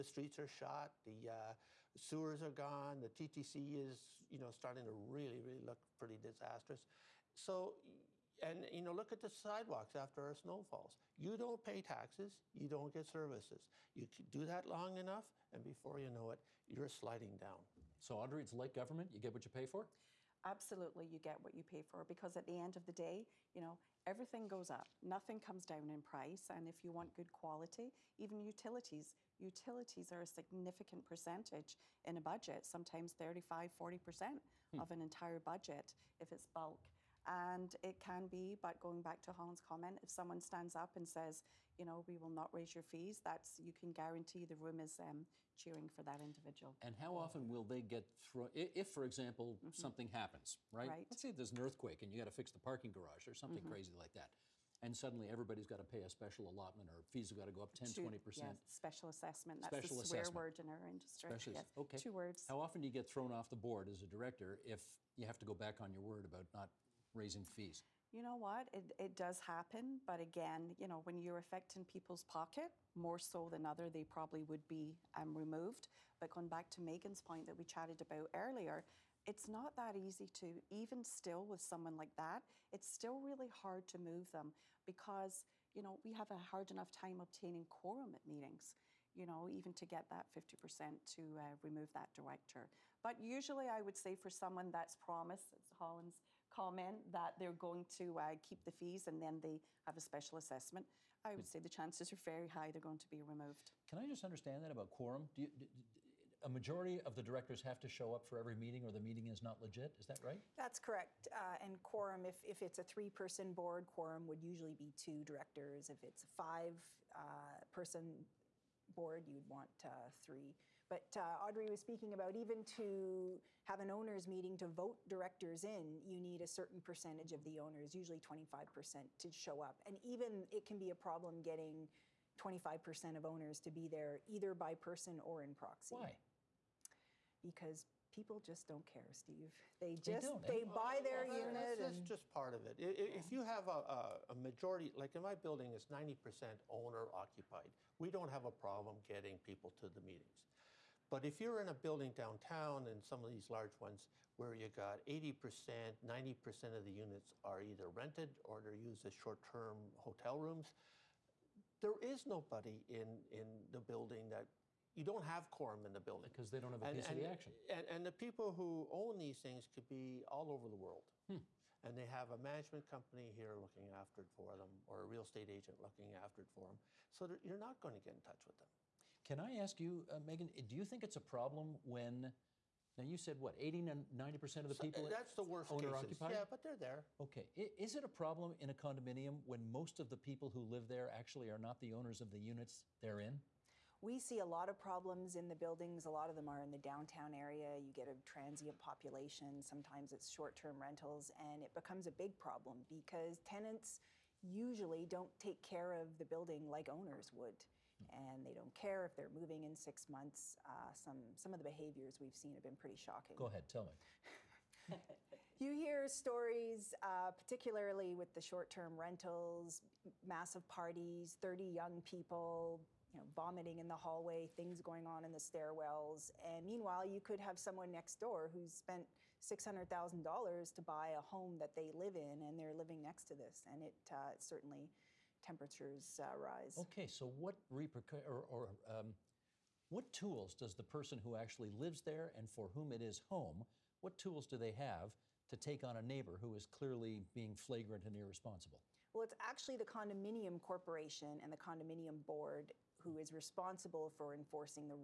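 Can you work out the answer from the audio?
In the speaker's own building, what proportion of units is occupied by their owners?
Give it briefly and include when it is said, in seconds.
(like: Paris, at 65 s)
90%, at 145 s.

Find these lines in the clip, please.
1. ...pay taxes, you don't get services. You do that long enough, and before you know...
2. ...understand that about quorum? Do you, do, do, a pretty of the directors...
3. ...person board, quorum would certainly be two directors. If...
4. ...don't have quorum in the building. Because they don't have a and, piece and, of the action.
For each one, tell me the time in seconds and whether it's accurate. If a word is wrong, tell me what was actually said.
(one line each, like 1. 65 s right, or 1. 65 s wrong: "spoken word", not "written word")
1. 11 s right
2. 104 s wrong: "majority", not "pretty"
3. 113 s wrong: "usually", not "certainly"
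4. 165 s right.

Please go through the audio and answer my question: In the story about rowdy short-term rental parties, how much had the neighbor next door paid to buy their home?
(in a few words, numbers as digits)
$600,000.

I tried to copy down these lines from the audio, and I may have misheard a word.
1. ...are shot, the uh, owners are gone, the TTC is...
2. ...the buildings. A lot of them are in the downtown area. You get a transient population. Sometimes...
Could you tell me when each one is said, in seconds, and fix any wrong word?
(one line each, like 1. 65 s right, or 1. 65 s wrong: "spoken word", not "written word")
1. 0 s wrong: "sewers", not "owners"
2. 195 s right.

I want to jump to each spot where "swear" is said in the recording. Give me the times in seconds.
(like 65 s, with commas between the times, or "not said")
60 s.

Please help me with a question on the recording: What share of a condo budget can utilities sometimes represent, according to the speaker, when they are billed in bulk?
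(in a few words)
35, 40%.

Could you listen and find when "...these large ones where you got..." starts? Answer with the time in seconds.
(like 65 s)
153 s.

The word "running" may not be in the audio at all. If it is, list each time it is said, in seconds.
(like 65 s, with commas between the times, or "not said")
not said.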